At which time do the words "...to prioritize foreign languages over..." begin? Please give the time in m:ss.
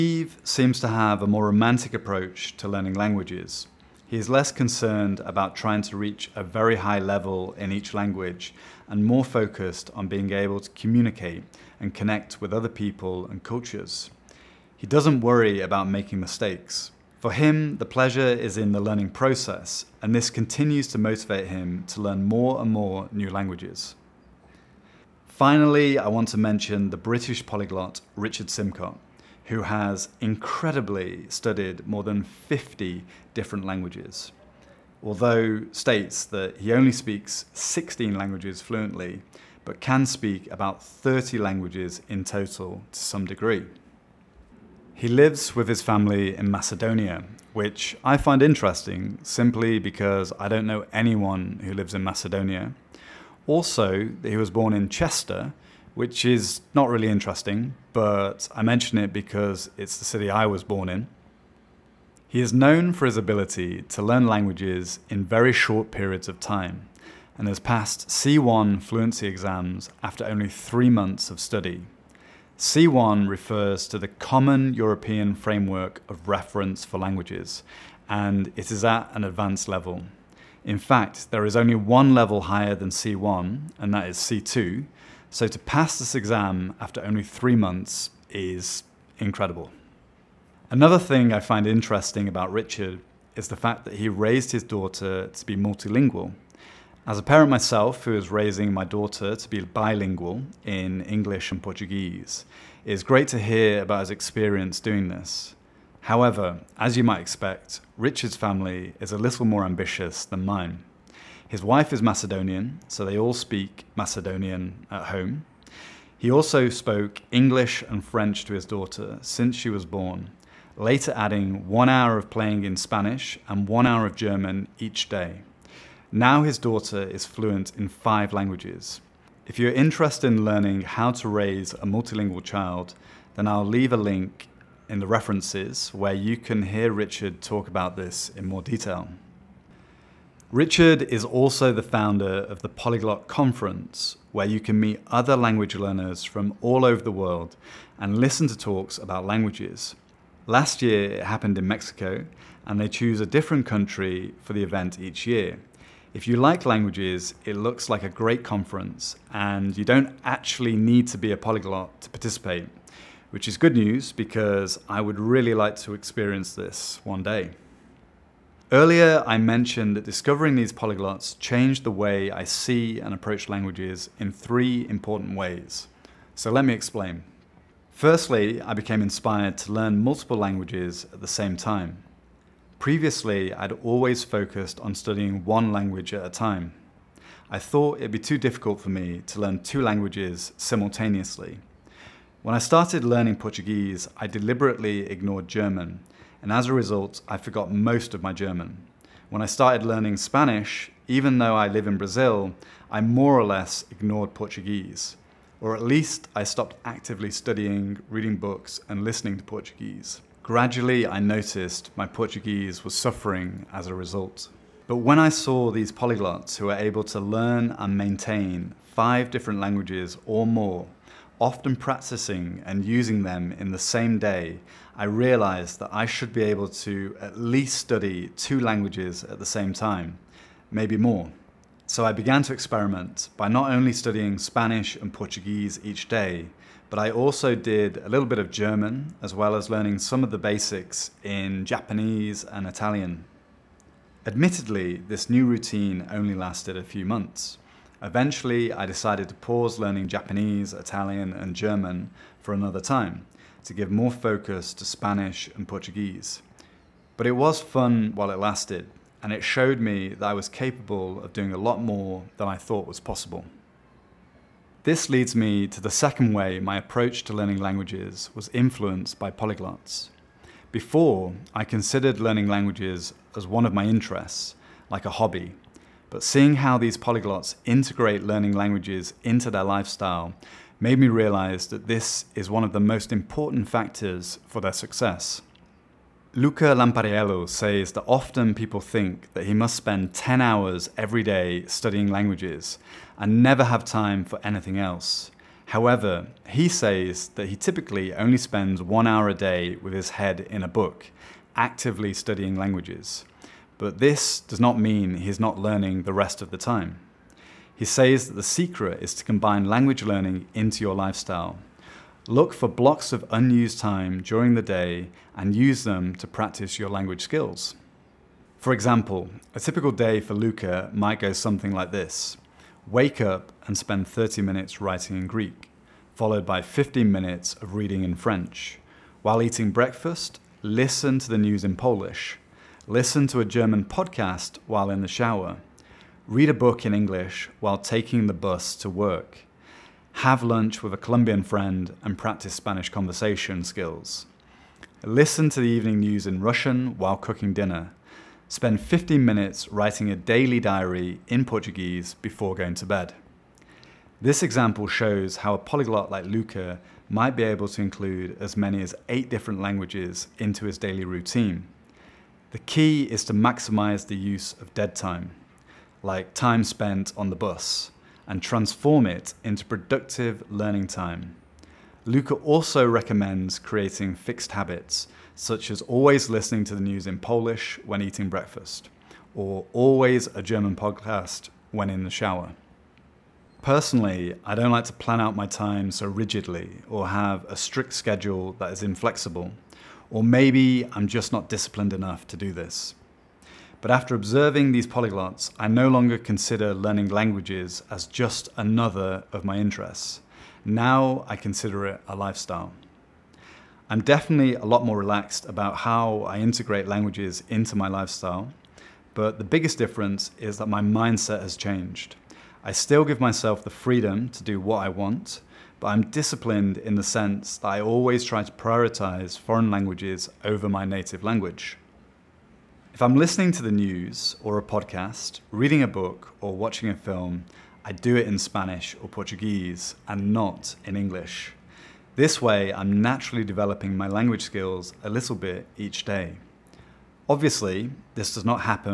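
6:58.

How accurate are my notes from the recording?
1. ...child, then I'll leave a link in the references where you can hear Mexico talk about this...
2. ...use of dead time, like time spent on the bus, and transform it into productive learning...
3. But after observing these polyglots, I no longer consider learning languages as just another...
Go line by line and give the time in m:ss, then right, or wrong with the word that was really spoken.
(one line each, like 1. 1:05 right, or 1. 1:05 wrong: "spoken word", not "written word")
1. 2:12 wrong: "Richard", not "Mexico"
2. 6:04 right
3. 6:33 right.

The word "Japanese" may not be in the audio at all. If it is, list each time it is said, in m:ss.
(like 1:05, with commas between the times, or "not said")
4:01, 4:10.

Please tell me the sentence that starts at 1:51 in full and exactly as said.
His wife is Macedonian, so they all speak Macedonian at home.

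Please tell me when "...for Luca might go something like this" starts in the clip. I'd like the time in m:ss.
5:20.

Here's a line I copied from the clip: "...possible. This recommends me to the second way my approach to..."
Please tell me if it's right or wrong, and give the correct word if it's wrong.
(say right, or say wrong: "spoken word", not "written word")
wrong: "leads", not "recommends".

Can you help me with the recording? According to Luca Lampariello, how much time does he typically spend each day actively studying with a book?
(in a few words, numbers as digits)
1 hour.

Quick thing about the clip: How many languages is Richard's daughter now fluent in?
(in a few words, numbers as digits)
5.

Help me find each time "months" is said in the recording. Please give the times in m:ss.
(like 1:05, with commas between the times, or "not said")
1:10, 1:27, 4:07.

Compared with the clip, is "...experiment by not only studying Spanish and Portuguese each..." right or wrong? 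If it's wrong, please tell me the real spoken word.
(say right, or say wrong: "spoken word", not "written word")
right.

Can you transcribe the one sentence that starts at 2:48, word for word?
Earlier, I mentioned that discovering these polyglots changed the way I see and approach languages in three important ways.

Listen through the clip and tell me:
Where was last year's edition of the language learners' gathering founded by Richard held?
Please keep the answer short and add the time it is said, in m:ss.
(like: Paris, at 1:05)
Mexico, at 2:31.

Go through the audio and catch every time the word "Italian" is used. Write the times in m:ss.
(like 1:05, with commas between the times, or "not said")
4:02, 4:10.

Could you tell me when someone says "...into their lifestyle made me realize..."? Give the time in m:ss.
4:39.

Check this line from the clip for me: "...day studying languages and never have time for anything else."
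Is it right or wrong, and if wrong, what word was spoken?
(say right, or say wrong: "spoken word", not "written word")
right.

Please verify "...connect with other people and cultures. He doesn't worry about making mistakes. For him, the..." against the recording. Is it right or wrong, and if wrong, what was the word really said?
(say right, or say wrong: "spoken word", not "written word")
right.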